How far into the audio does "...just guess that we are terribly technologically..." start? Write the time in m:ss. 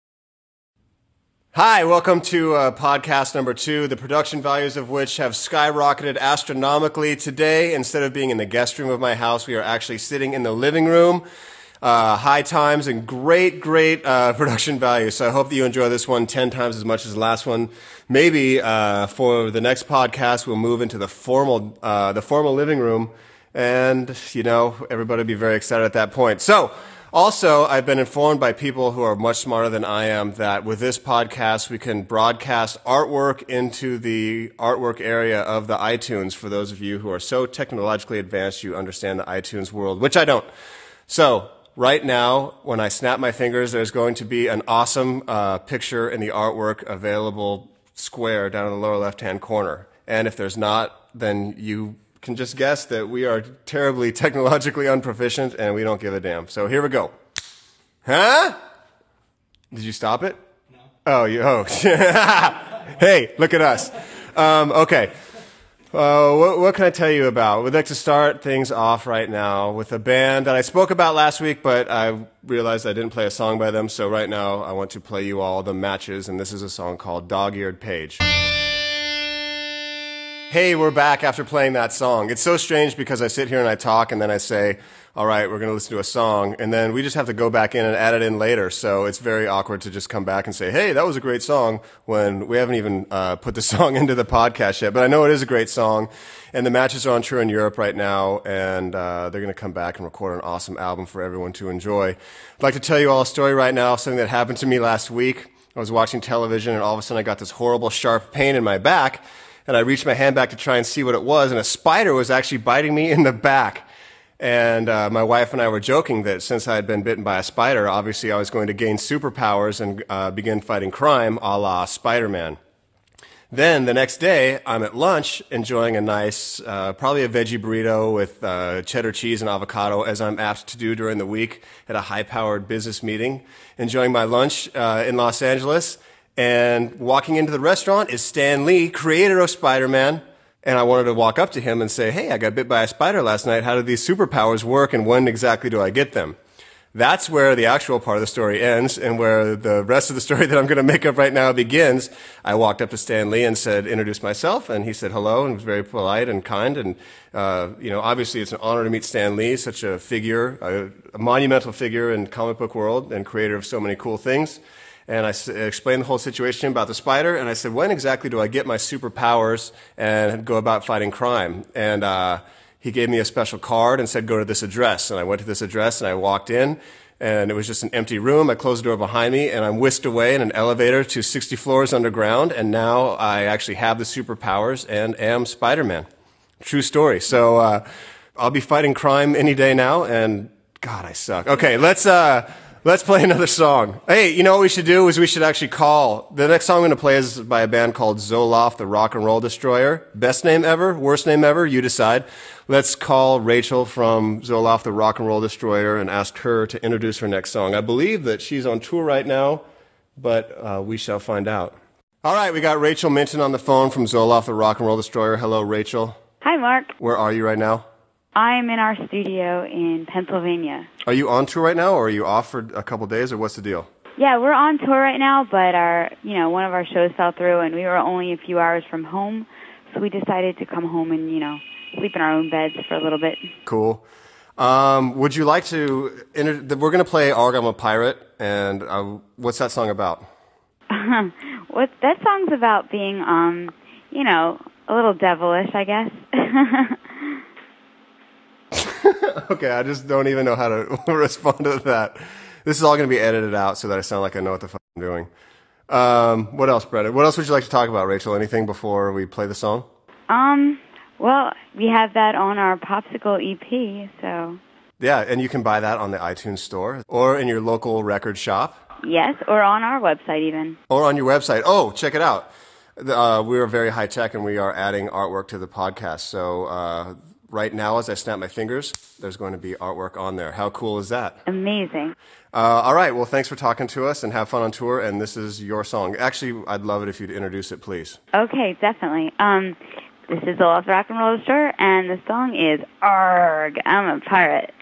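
0:52.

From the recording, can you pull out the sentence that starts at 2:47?
And I said, when exactly do I get my superpowers and go about fighting crime?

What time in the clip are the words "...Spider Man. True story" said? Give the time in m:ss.
3:05.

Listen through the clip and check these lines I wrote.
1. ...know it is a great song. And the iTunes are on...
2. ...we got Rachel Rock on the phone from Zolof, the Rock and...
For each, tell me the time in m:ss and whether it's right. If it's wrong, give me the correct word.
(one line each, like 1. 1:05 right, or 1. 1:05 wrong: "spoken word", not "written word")
1. 1:35 wrong: "matches", not "iTunes"
2. 3:32 wrong: "Minton", not "Rock".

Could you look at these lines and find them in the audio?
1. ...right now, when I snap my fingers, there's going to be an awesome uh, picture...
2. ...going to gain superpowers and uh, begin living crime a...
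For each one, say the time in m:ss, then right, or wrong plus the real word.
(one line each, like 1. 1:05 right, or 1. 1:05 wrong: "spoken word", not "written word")
1. 0:41 right
2. 1:58 wrong: "fighting", not "living".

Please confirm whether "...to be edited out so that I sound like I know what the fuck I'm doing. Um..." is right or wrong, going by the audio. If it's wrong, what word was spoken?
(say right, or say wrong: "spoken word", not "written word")
right.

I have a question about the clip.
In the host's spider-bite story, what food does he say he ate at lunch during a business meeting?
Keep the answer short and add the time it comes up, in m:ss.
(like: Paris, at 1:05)
Veggie burrito, at 2:07.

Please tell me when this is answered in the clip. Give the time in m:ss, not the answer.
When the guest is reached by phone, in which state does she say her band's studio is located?
3:40.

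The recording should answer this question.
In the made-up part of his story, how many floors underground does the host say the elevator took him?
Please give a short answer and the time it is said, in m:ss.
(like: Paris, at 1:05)
60, at 3:01.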